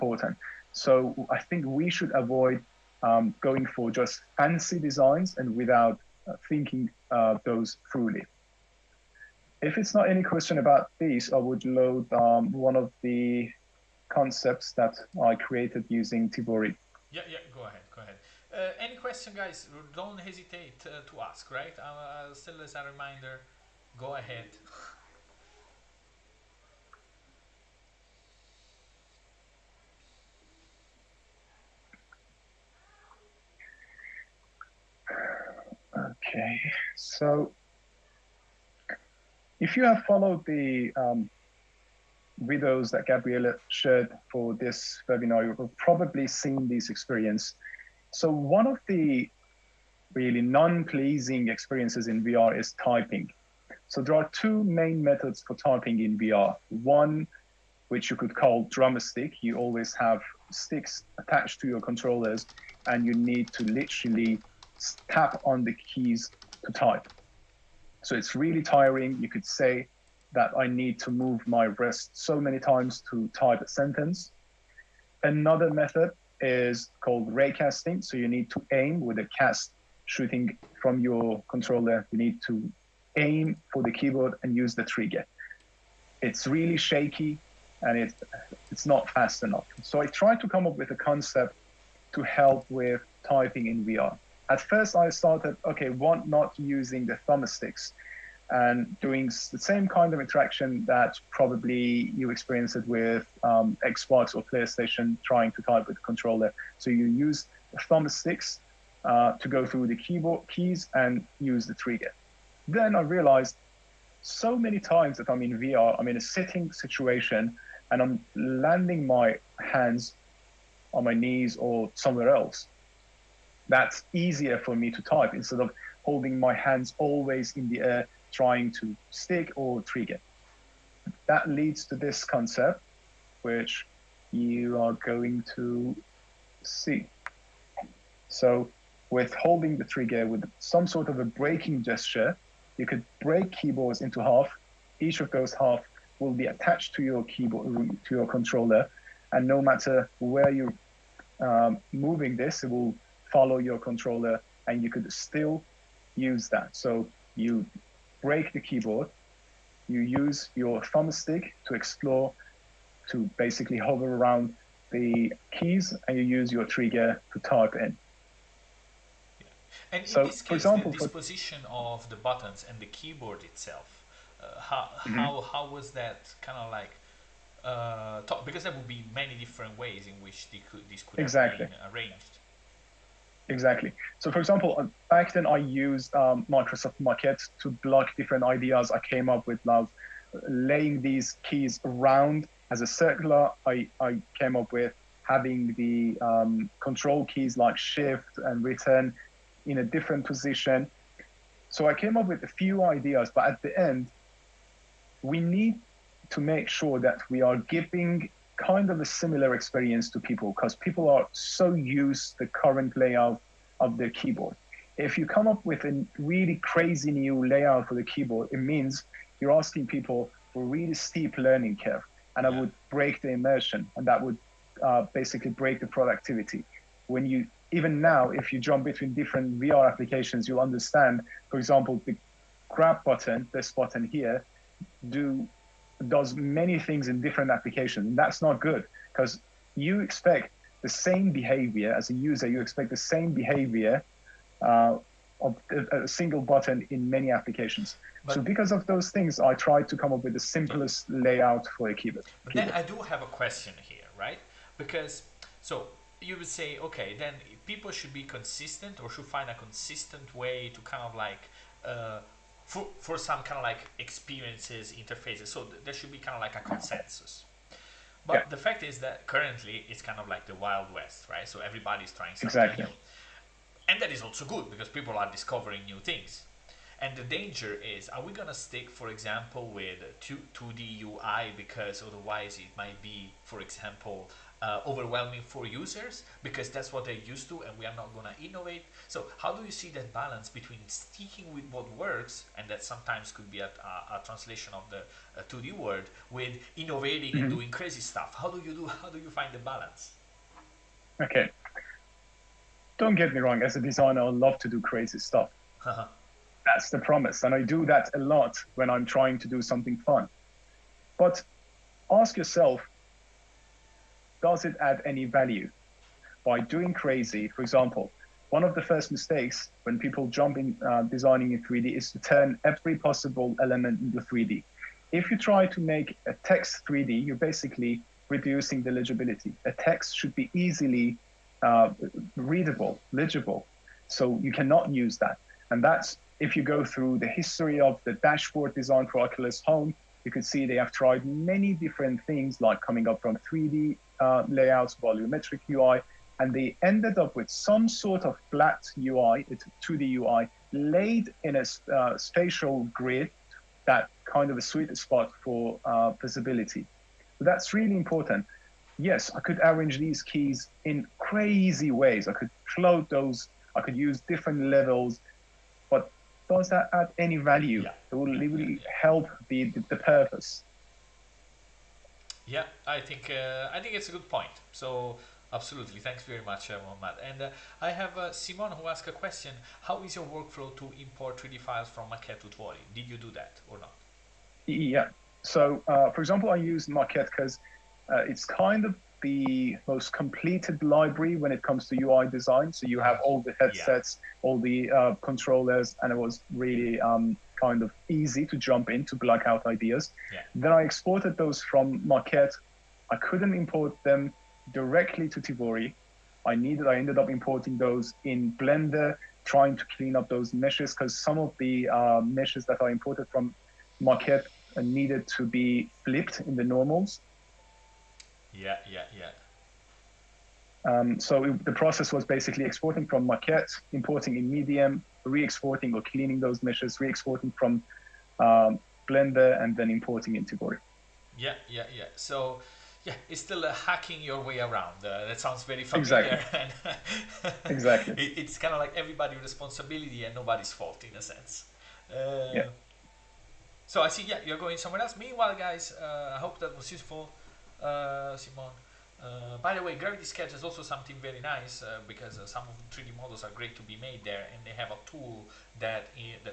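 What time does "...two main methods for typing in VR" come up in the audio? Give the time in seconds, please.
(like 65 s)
54 s.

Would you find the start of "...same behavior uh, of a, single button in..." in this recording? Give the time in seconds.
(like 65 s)
242 s.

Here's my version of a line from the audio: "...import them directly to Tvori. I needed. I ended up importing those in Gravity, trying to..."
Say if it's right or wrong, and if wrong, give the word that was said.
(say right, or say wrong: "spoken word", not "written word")
wrong: "Blender", not "Gravity".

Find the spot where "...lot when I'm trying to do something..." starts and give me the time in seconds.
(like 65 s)
308 s.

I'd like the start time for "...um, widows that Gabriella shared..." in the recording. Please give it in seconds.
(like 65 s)
40 s.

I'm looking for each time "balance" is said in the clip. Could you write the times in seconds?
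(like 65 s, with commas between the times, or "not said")
290 s, 299 s.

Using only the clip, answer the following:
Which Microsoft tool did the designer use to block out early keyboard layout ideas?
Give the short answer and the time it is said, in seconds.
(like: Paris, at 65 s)
Microsoft Maquette, at 186 s.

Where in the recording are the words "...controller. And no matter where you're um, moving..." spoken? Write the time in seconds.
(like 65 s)
148 s.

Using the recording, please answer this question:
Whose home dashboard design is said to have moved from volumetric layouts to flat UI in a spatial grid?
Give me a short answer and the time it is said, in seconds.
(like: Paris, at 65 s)
Oculus Home, at 339 s.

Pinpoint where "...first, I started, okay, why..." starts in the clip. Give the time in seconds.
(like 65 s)
94 s.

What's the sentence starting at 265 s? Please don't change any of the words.
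So th- there should be kind of like a consensus.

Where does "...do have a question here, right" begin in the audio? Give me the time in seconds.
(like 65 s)
252 s.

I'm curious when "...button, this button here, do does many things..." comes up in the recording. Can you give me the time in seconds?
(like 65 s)
233 s.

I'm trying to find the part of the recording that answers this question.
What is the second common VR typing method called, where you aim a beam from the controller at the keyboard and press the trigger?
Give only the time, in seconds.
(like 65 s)
77 s.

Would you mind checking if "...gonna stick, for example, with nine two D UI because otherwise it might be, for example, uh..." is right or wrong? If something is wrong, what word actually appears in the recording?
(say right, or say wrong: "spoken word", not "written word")
wrong: "two", not "nine".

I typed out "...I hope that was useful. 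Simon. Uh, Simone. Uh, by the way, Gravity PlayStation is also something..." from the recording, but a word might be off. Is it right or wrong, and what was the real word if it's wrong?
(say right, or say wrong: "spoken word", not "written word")
wrong: "Sketch", not "PlayStation".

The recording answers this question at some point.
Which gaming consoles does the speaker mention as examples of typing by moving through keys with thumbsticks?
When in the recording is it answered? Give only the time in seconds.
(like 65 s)
103 s.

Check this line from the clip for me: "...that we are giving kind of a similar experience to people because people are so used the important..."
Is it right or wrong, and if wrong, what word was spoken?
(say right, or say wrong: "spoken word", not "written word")
wrong: "current", not "important".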